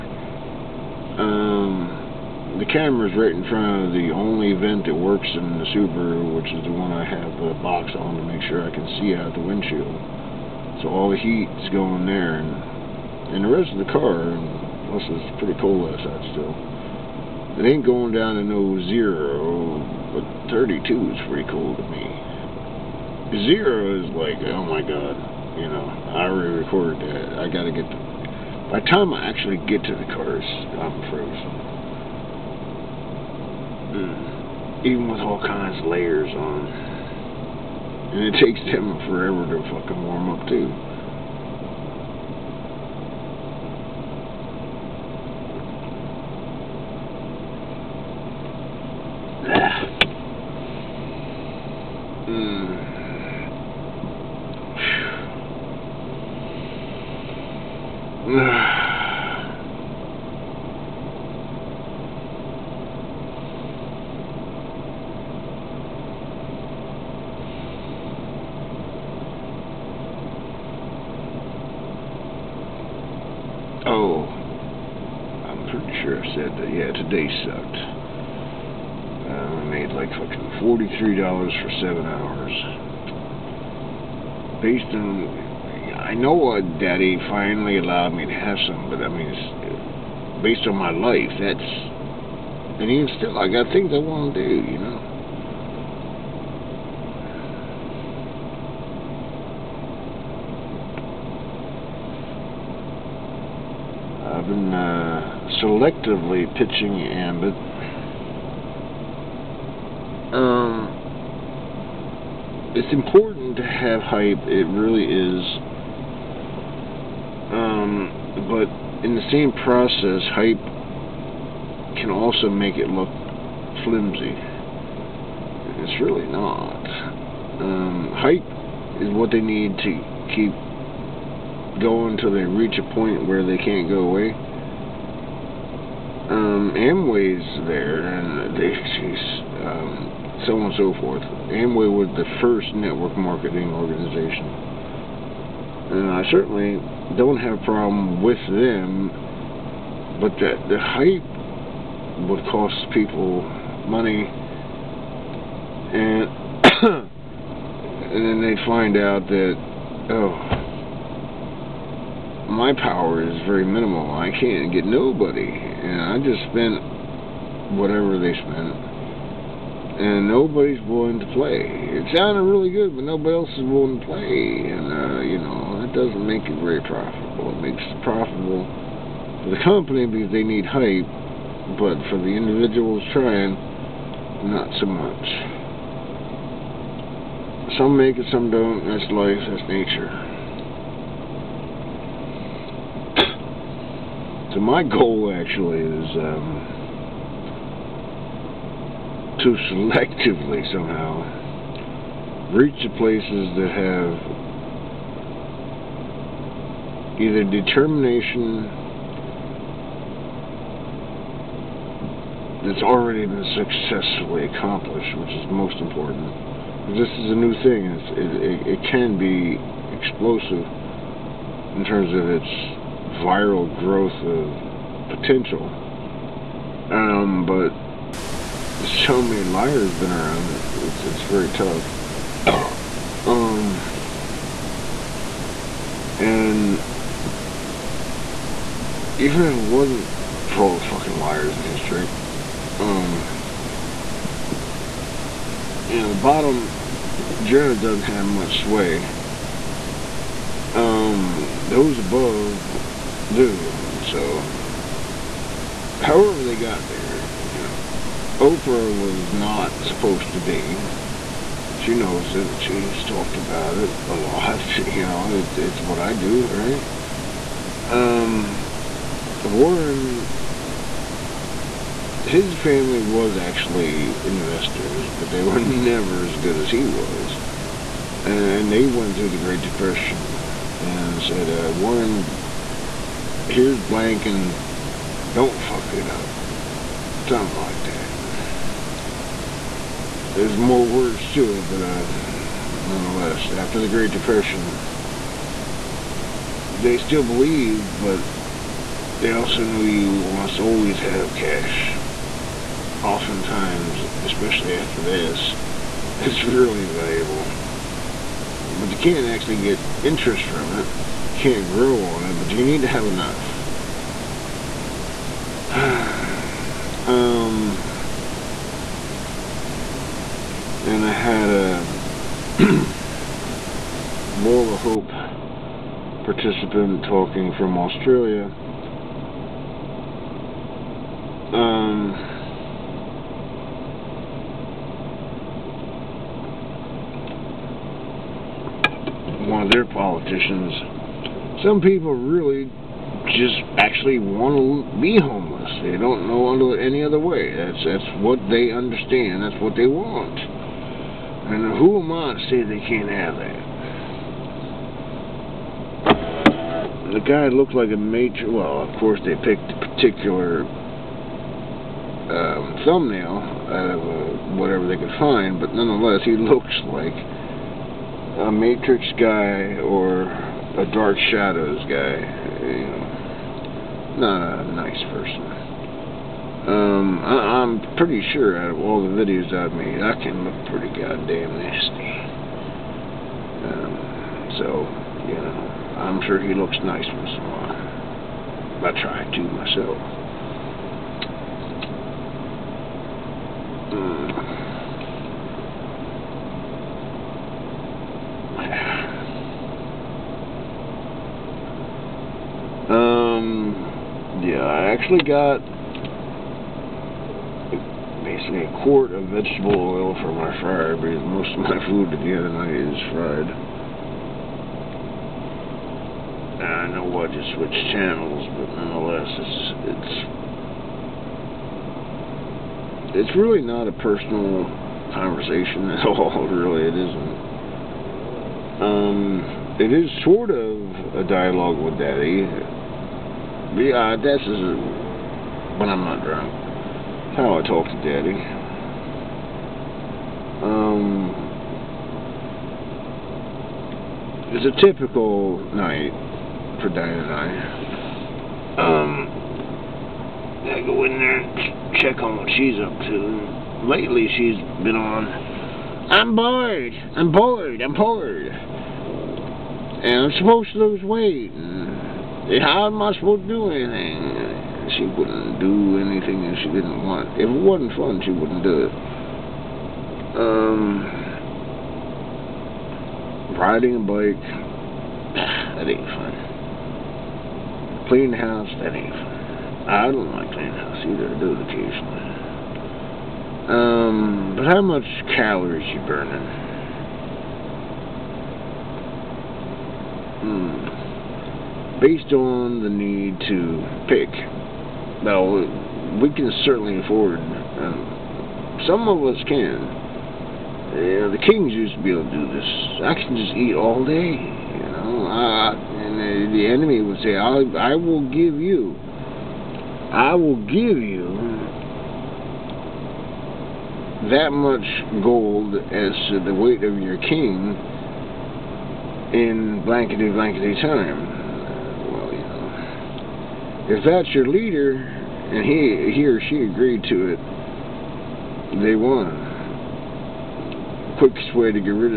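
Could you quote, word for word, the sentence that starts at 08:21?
the kings used to be able to do this.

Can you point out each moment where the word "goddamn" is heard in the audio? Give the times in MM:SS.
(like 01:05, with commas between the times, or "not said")
06:20.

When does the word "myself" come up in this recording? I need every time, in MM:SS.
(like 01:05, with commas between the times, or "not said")
06:29.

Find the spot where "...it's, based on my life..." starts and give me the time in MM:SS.
01:29.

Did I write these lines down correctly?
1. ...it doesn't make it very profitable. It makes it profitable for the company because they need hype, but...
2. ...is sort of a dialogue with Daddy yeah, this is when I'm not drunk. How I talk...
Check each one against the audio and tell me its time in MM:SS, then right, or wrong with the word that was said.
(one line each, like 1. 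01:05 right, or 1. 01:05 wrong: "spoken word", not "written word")
1. 02:55 right
2. 07:09 right.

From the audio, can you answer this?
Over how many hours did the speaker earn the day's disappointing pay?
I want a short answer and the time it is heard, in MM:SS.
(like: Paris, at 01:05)
7, at 01:21.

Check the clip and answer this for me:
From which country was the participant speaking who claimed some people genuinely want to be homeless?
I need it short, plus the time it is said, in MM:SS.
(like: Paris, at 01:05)
Australia, at 05:27.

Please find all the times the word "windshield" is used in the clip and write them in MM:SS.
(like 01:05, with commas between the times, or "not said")
00:09.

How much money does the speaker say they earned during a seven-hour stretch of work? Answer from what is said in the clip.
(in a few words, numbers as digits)
$43.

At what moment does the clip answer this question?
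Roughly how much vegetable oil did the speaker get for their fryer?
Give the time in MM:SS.
06:48.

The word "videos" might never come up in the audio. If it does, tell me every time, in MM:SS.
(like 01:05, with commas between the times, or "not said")
06:19.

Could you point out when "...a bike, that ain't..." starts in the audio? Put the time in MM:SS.
07:53.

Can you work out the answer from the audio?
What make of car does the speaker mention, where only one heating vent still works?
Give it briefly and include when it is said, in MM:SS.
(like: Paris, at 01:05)
Subaru, at 00:05.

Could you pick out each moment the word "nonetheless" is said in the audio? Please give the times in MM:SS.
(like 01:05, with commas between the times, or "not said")
04:52, 06:05, 06:58.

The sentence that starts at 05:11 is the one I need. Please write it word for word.
You can't grow on it, but you need to have enough.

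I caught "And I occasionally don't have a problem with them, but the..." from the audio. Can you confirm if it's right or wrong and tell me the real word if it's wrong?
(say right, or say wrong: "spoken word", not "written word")
wrong: "certainly", not "occasionally".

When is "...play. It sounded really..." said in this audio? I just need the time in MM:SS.
02:51.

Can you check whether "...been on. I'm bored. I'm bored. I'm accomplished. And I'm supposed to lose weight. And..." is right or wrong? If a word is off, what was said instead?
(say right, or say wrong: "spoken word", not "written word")
wrong: "bored", not "accomplished".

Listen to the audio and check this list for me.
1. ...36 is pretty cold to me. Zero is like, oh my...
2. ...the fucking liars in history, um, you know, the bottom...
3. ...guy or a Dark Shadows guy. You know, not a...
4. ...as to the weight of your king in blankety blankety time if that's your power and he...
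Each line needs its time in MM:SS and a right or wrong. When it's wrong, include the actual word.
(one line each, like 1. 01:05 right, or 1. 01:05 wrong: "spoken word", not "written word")
1. 00:20 wrong: "32", not "36"
2. 04:00 right
3. 06:09 right
4. 08:35 wrong: "leader", not "power".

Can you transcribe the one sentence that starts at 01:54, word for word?
It really is um, but in the same process, hype can also make it look flimsy.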